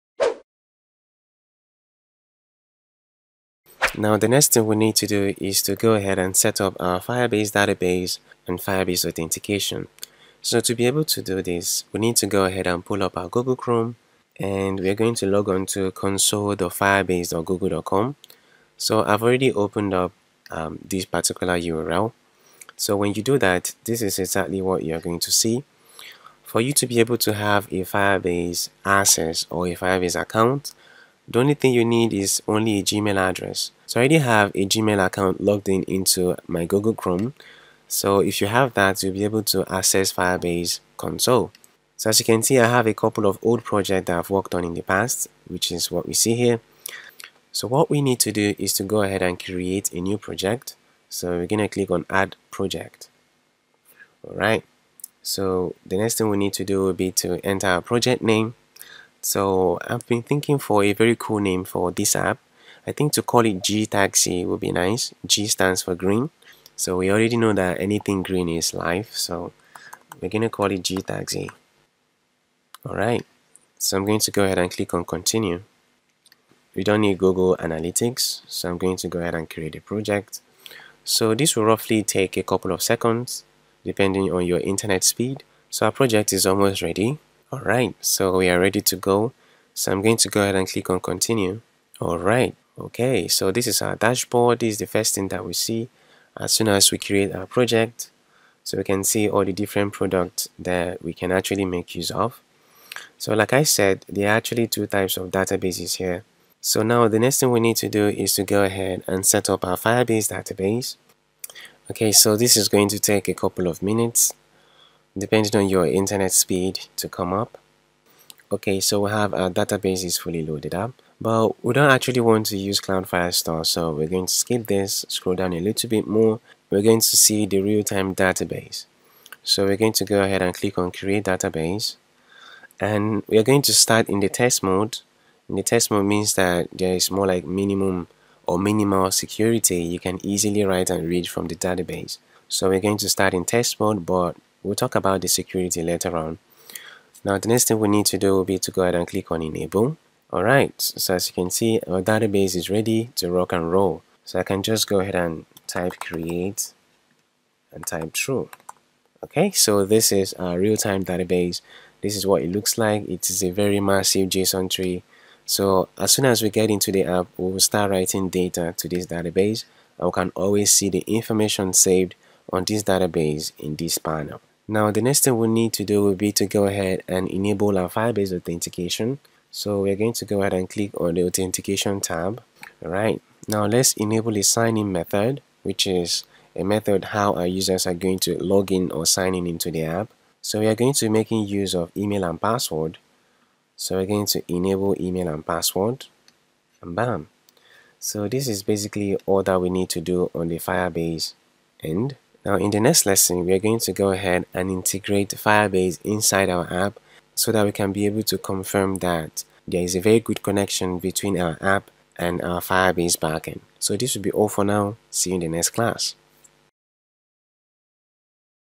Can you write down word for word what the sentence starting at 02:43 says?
It is a very massive JSON tree.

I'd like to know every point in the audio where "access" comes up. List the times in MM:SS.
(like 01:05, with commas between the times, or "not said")
00:28, 00:39.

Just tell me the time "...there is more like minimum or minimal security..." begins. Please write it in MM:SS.
02:16.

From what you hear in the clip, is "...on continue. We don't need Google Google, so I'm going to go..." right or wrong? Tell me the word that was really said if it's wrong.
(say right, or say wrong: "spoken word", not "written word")
wrong: "Analytics", not "Google".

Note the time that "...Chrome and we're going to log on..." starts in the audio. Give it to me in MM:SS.
00:13.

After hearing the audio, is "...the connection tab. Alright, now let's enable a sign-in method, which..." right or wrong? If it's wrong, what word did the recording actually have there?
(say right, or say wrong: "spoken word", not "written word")
wrong: "authentication", not "connection".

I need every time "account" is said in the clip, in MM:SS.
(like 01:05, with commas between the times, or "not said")
00:30, 00:35.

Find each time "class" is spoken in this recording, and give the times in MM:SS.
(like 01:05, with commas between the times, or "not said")
03:35.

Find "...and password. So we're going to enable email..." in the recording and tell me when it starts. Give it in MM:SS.
03:12.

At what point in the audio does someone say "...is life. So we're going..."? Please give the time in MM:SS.
01:08.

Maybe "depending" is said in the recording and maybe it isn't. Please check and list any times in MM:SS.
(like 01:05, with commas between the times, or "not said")
01:23, 01:55.